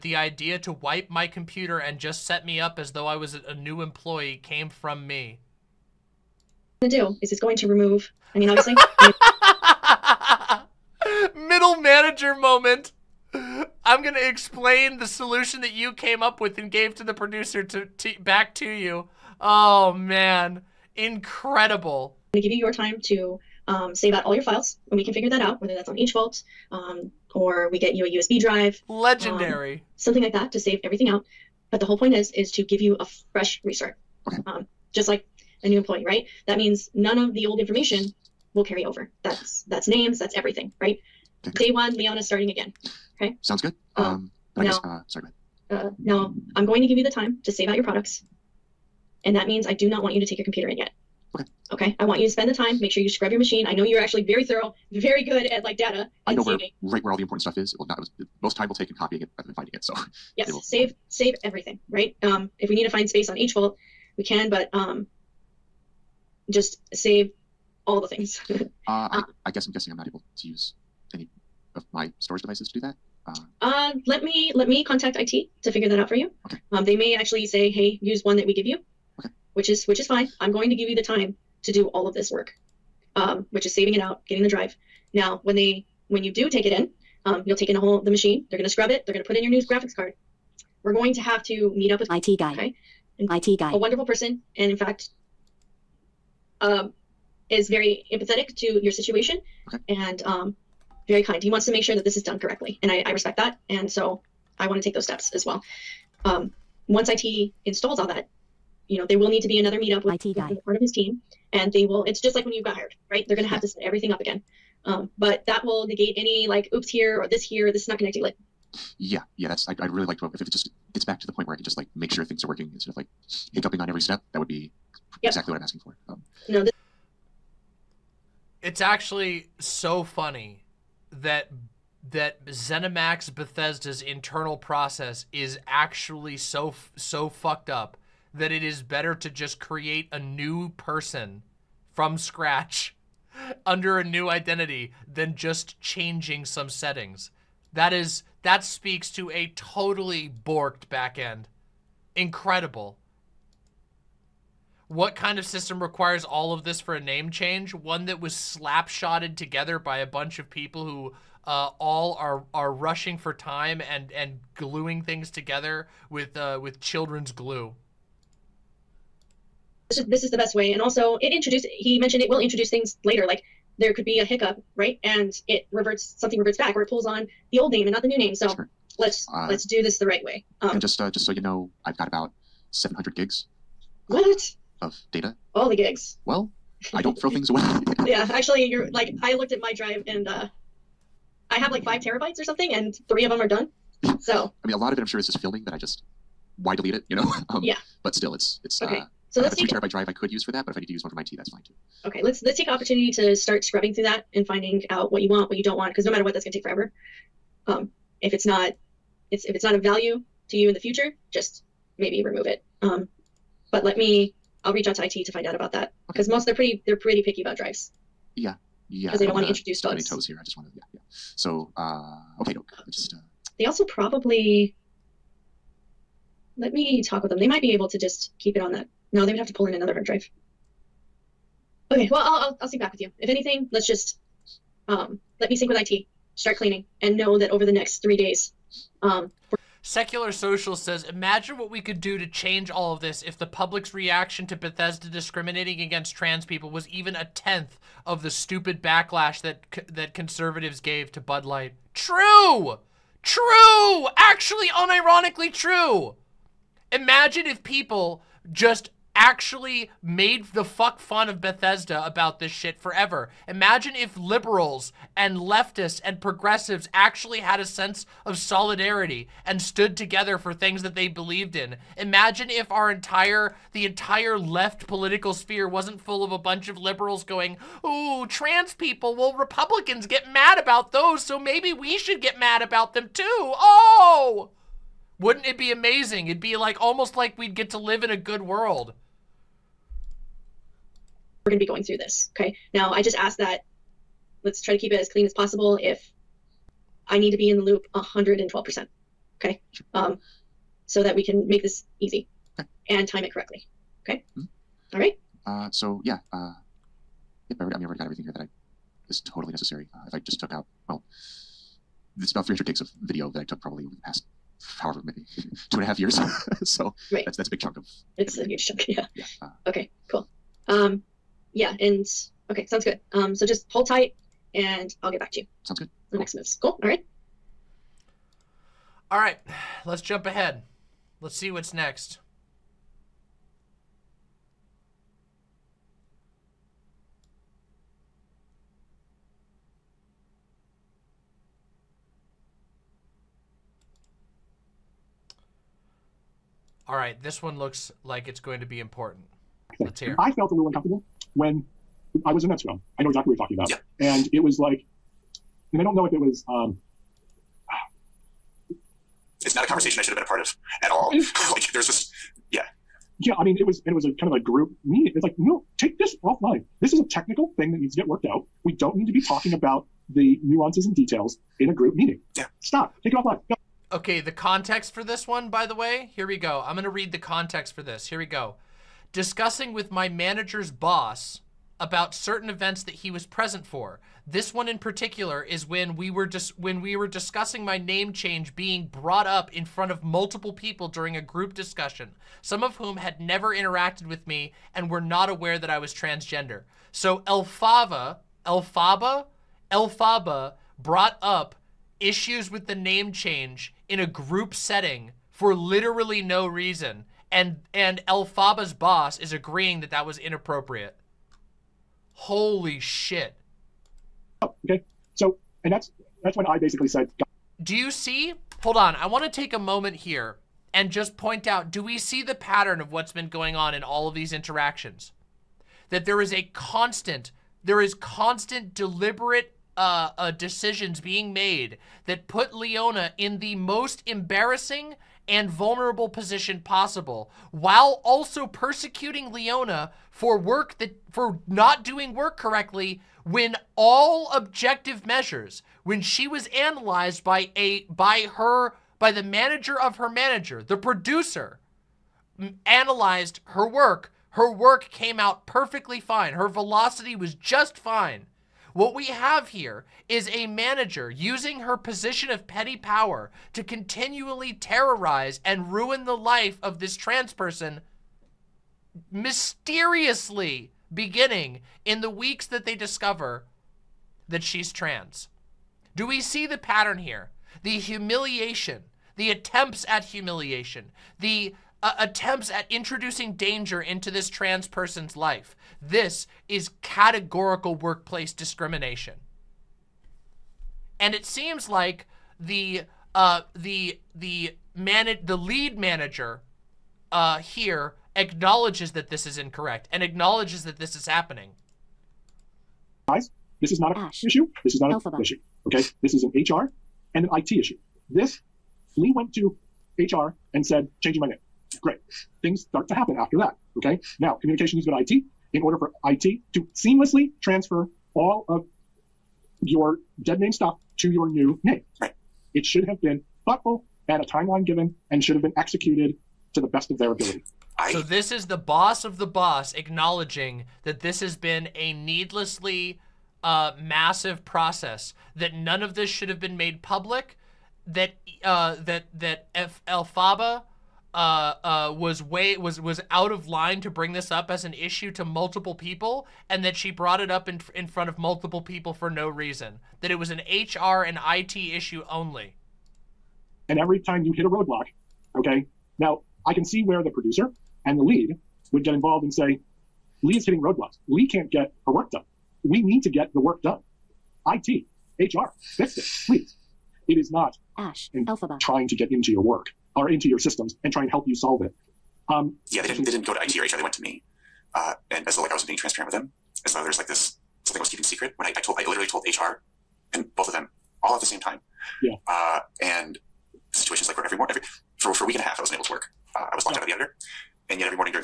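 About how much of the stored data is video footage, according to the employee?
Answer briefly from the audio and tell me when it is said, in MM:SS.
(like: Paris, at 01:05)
300 gigs, at 05:12.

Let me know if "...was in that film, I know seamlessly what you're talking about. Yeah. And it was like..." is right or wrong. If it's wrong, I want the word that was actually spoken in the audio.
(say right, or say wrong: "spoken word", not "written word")
wrong: "exactly", not "seamlessly".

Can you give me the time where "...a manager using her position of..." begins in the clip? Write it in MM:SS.
07:40.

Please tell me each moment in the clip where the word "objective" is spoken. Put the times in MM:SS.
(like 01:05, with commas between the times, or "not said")
07:24.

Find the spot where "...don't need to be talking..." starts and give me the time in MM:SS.
06:08.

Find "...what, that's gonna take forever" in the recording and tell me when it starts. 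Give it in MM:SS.
03:26.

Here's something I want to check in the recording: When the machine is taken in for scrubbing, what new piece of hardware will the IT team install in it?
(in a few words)
graphics card.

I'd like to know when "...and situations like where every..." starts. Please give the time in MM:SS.
09:42.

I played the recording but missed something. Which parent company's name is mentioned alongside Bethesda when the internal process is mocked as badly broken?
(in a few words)
ZeniMax.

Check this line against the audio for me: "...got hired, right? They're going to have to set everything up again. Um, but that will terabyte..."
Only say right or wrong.
wrong.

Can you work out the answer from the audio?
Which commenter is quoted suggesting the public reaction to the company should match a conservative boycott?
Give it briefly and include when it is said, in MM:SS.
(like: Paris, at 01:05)
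Secular Social, at 03:59.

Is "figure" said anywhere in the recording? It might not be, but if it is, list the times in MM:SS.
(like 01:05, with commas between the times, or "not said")
00:25, 01:15.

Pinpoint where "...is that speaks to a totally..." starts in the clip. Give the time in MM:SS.
02:27.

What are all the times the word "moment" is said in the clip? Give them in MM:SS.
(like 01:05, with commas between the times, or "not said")
00:12, 06:59.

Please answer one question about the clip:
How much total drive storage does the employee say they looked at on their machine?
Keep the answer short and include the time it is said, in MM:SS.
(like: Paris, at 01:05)
5 terabytes, at 03:11.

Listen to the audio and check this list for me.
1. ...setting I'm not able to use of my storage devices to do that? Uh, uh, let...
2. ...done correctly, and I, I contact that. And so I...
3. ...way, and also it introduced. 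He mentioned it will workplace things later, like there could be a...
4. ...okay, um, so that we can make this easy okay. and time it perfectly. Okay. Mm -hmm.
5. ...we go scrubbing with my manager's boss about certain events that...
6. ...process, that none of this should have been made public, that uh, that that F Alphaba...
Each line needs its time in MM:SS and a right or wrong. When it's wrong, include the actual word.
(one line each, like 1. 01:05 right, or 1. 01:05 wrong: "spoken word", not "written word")
1. 01:09 wrong: "guessing", not "setting"
2. 01:42 wrong: "respect", not "contact"
3. 02:50 wrong: "introduce", not "workplace"
4. 04:59 wrong: "correctly", not "perfectly"
5. 06:18 wrong: "discussing", not "scrubbing"
6. 08:54 right.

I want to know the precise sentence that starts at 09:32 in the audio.
Um, yeah, they didn't, they didn't go to HR.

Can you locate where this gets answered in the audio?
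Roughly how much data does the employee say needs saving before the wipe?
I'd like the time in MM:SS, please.
03:02.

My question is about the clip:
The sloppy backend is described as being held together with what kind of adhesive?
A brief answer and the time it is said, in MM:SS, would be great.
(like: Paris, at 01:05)
children's glue, at 02:46.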